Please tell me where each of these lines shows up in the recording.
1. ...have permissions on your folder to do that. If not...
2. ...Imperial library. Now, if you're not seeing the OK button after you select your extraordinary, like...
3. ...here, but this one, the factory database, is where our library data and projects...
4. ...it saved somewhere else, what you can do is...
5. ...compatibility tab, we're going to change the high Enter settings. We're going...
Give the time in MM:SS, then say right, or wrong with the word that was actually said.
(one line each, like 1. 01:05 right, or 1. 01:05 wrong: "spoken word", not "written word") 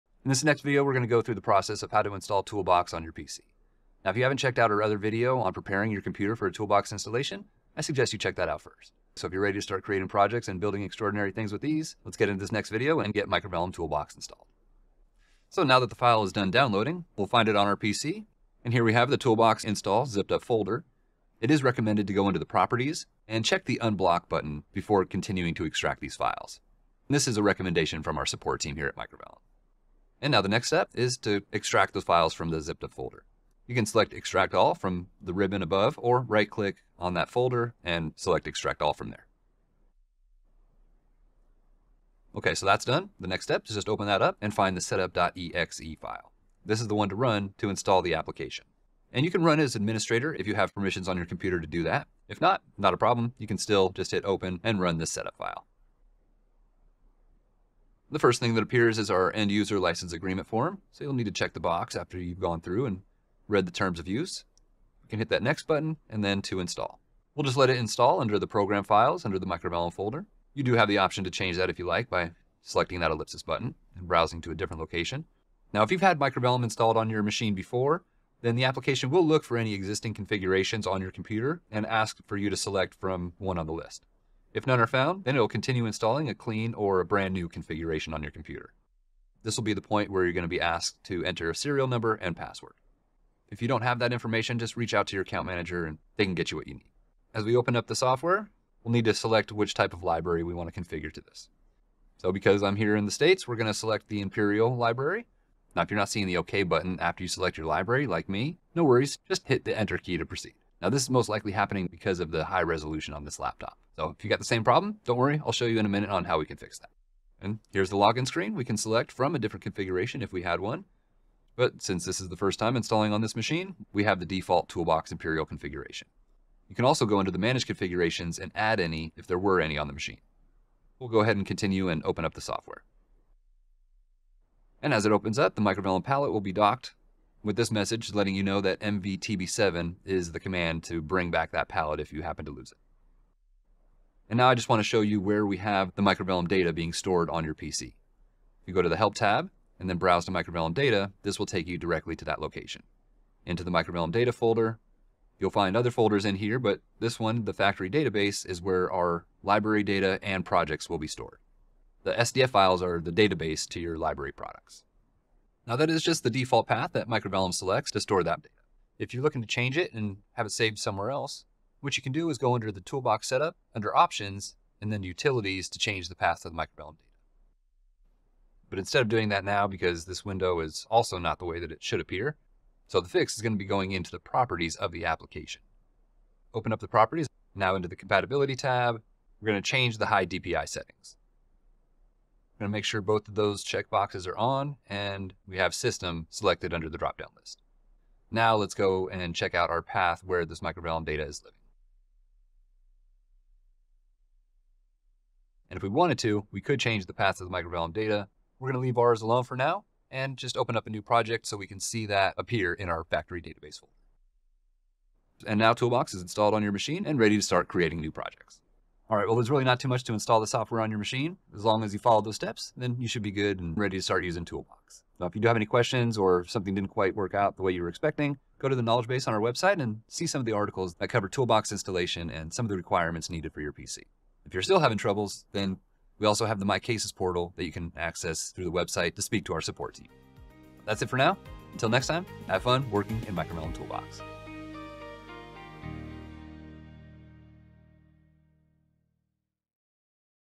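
1. 00:50 wrong: "computer", not "folder"
2. 01:44 wrong: "library", not "extraordinary"
3. 02:36 right
4. 02:50 right
5. 03:07 wrong: "DPI", not "Enter".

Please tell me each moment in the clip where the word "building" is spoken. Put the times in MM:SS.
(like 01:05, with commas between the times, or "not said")
00:10.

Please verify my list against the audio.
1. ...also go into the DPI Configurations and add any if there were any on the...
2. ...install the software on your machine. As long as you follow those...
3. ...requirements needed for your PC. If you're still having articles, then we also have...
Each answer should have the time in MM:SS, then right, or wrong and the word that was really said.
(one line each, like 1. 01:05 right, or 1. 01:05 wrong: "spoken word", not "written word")
1. 02:06 wrong: "Manage", not "DPI"
2. 03:40 right
3. 03:52 wrong: "troubles", not "articles".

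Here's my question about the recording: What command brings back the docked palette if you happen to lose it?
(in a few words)
MVTB7.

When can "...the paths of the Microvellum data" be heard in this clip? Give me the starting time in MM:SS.
03:27.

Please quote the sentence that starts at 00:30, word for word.
And now the next step is to extract those files from the zip up folder.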